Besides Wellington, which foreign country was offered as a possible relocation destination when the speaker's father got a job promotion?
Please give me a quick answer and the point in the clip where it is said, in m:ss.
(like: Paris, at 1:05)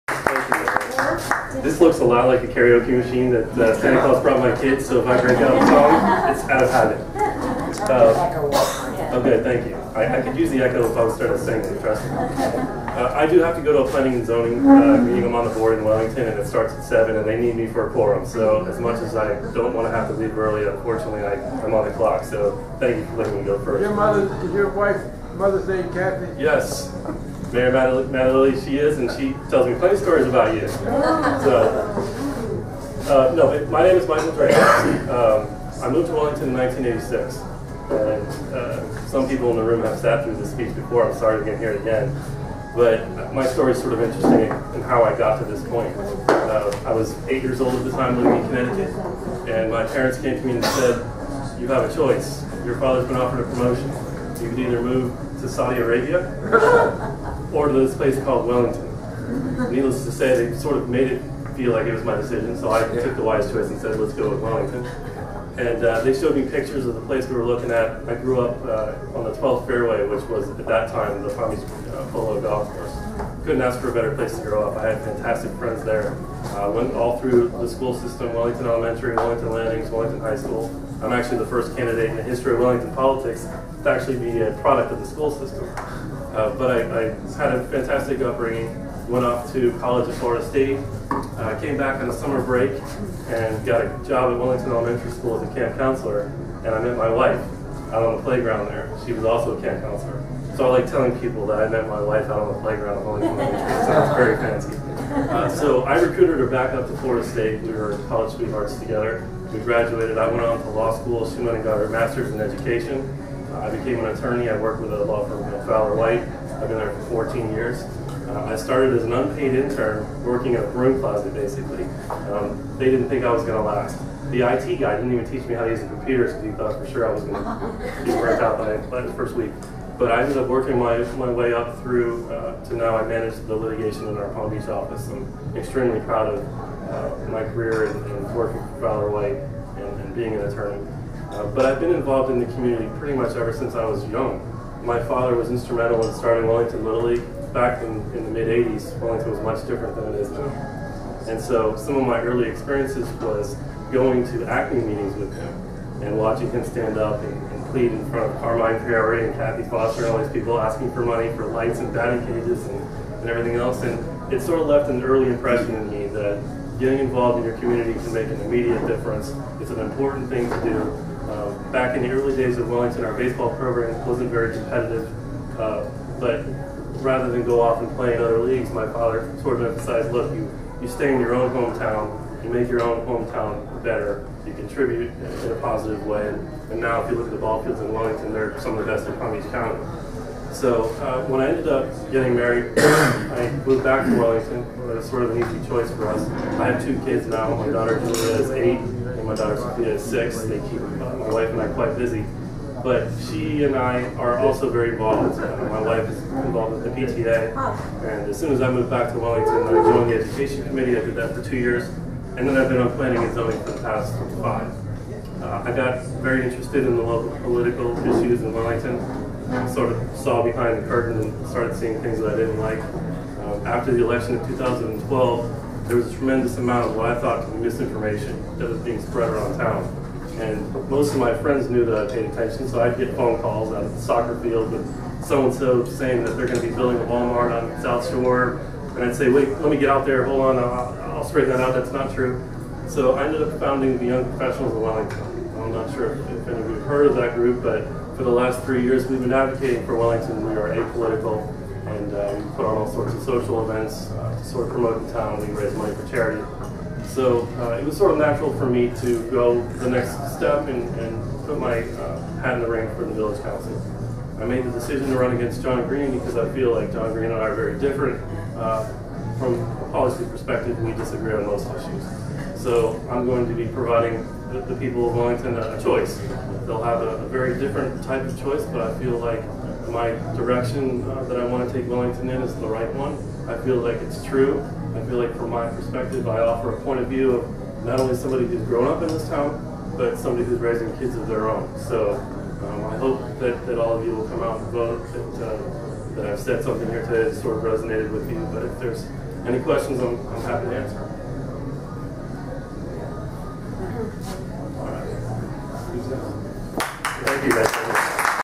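Saudi Arabia, at 0:55.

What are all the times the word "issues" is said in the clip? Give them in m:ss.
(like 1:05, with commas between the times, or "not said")
3:38, 4:31.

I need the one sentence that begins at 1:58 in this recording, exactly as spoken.
Uh, I started as an unpaid intern working at a broom closet, basically.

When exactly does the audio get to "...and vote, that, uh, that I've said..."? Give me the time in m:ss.
4:54.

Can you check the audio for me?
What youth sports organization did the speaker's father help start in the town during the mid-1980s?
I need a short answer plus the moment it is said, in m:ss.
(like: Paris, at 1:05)
Wellington Little League, at 2:26.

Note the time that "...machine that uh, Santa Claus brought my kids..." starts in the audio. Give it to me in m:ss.
0:03.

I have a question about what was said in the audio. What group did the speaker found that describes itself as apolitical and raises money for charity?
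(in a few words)
Young Professionals of Wellington.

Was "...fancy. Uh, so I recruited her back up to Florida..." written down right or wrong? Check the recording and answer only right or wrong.
right.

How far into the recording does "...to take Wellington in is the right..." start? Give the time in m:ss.
4:41.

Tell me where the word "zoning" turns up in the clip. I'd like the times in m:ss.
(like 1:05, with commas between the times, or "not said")
0:14, 3:33.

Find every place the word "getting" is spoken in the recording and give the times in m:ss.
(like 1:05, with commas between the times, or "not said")
2:46, 3:12.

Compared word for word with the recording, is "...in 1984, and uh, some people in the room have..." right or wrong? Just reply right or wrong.
wrong.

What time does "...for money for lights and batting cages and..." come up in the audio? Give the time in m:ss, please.
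2:40.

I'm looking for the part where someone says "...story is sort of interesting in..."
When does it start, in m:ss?
0:43.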